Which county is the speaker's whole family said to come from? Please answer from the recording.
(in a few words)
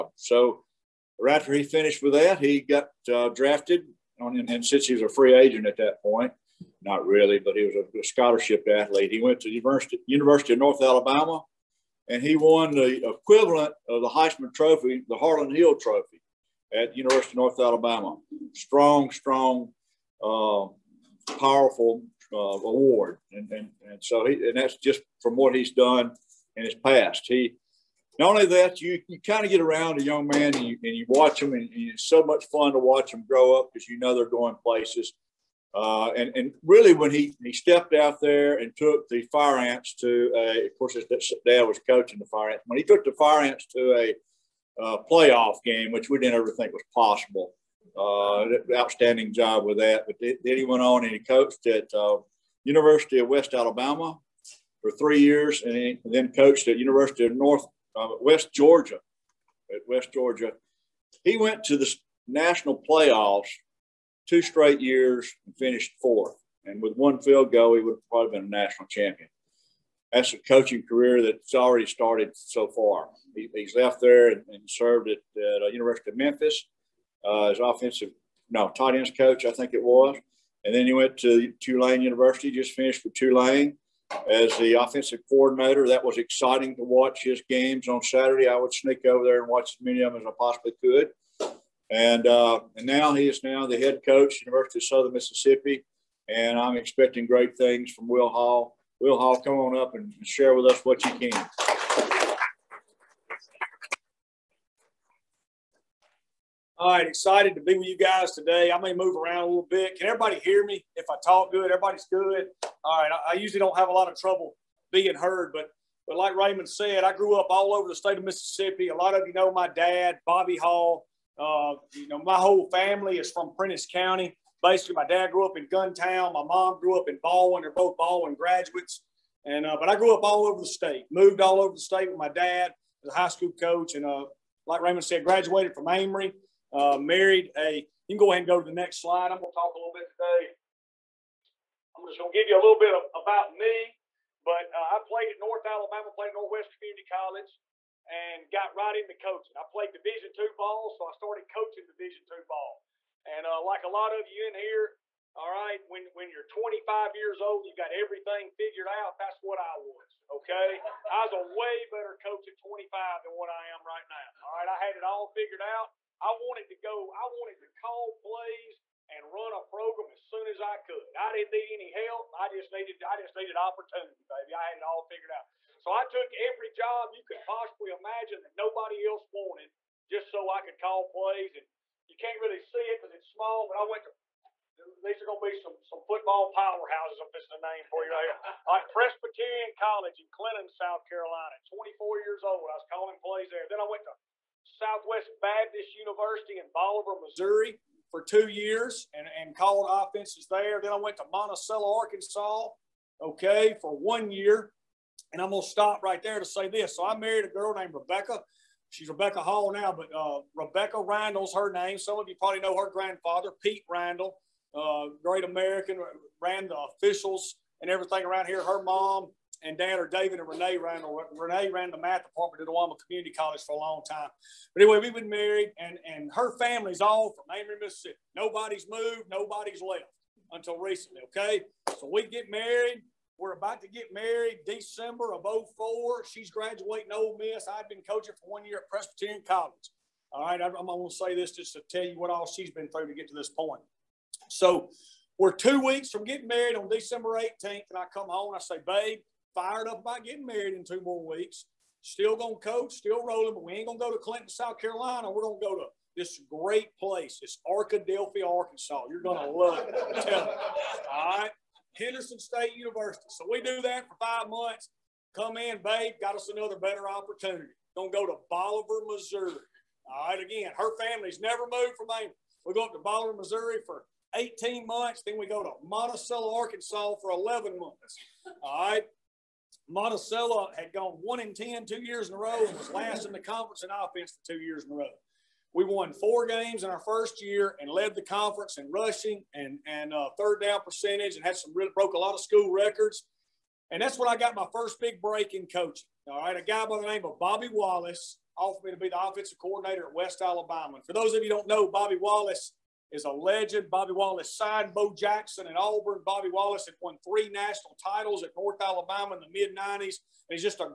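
Prentiss County.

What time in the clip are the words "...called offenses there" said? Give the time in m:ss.
3:19.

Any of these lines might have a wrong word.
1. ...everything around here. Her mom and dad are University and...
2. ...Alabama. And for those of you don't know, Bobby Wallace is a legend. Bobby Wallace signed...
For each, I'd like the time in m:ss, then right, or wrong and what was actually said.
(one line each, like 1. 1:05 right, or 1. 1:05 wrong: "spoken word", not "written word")
1. 3:37 wrong: "David", not "University"
2. 5:00 right.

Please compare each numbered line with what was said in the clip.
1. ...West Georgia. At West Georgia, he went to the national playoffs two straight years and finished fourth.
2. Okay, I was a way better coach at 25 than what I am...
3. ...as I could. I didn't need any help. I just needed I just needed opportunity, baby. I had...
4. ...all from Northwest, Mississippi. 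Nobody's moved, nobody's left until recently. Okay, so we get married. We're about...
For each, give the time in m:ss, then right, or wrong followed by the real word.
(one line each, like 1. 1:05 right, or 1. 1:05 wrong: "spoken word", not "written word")
1. 0:58 right
2. 2:40 right
3. 2:50 right
4. 3:46 wrong: "Amory", not "Northwest".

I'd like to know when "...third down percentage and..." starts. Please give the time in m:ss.
4:50.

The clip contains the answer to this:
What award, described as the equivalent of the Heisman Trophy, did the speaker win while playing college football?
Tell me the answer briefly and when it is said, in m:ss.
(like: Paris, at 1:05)
Harlan Hill Trophy, at 0:15.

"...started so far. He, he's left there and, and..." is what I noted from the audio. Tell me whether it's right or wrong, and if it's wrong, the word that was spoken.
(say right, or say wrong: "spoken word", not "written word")
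right.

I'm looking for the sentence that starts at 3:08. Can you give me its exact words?
i Presbyterian College in Clinton, South Carolina.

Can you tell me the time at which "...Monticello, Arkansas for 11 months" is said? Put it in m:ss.
4:35.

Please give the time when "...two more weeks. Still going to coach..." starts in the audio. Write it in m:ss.
4:10.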